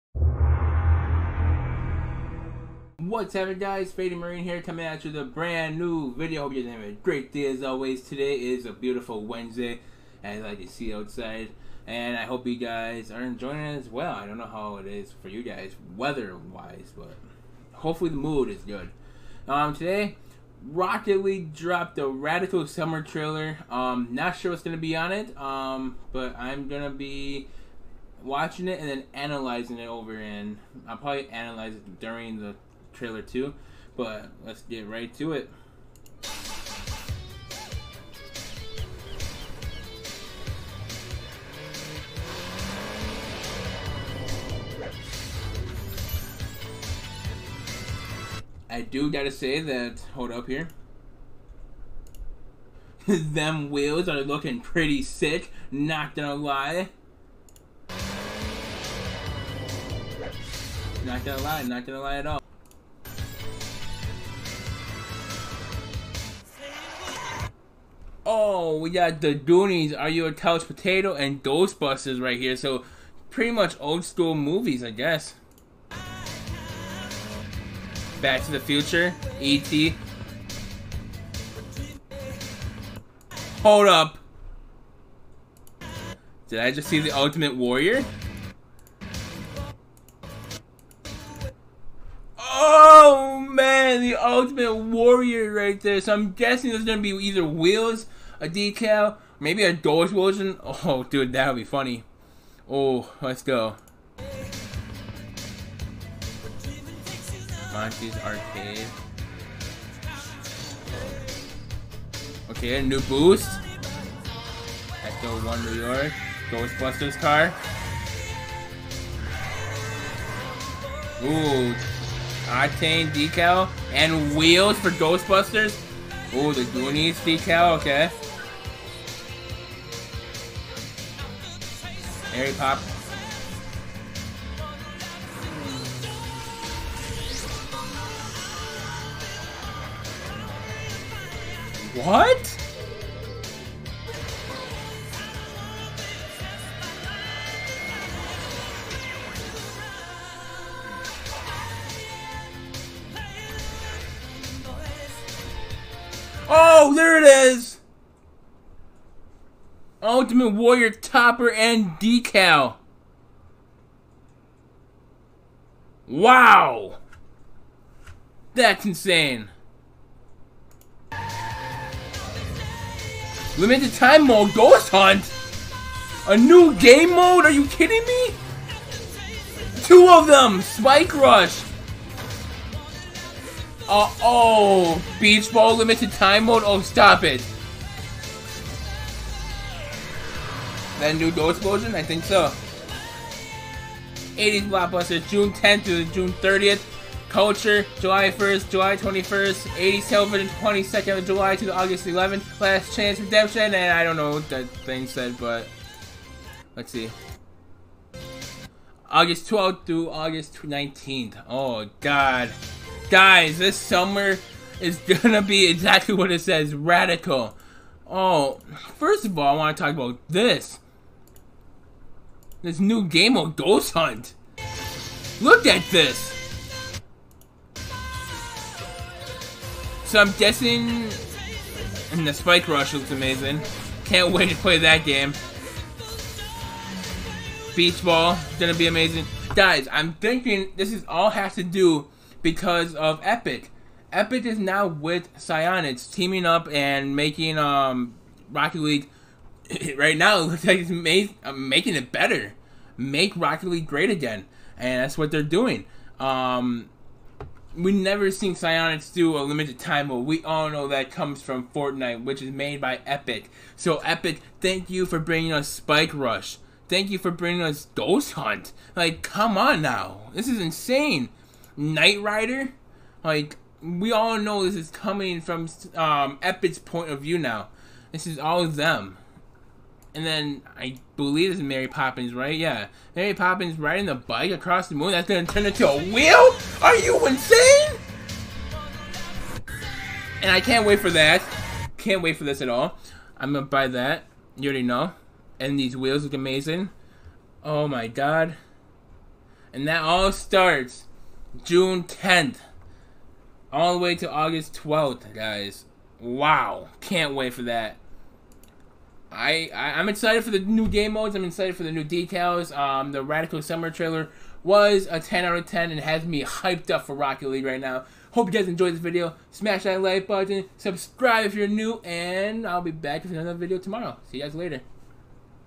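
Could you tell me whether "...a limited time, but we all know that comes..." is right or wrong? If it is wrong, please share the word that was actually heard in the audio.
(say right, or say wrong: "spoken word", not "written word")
right.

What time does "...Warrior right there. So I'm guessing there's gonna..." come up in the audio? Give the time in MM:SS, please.
01:34.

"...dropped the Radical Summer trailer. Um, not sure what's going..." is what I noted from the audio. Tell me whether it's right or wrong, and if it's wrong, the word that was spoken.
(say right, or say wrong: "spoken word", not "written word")
right.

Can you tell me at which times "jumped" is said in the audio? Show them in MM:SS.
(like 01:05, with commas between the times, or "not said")
not said.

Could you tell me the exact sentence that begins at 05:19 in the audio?
Smash that like button, subscribe if you're new, and I'll be back with another video tomorrow.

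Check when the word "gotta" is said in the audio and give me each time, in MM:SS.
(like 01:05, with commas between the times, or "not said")
00:49.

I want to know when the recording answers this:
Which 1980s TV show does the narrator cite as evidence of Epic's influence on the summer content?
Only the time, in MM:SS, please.
04:31.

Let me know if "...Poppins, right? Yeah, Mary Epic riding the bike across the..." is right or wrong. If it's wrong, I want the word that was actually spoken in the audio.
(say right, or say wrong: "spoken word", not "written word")
wrong: "Poppins", not "Epic".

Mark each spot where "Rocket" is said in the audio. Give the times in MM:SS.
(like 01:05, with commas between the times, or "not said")
00:20, 04:08, 04:13, 05:17.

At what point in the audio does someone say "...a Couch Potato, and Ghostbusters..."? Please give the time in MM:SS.
01:10.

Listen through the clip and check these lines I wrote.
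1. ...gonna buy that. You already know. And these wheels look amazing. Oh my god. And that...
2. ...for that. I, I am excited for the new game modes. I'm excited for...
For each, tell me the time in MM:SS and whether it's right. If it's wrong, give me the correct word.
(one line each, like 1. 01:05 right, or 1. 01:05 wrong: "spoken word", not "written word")
1. 04:53 right
2. 05:07 right.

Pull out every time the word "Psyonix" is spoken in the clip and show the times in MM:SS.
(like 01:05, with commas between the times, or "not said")
04:05, 04:18.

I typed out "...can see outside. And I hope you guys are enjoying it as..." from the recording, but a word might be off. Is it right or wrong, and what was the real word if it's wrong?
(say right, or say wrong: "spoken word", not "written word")
right.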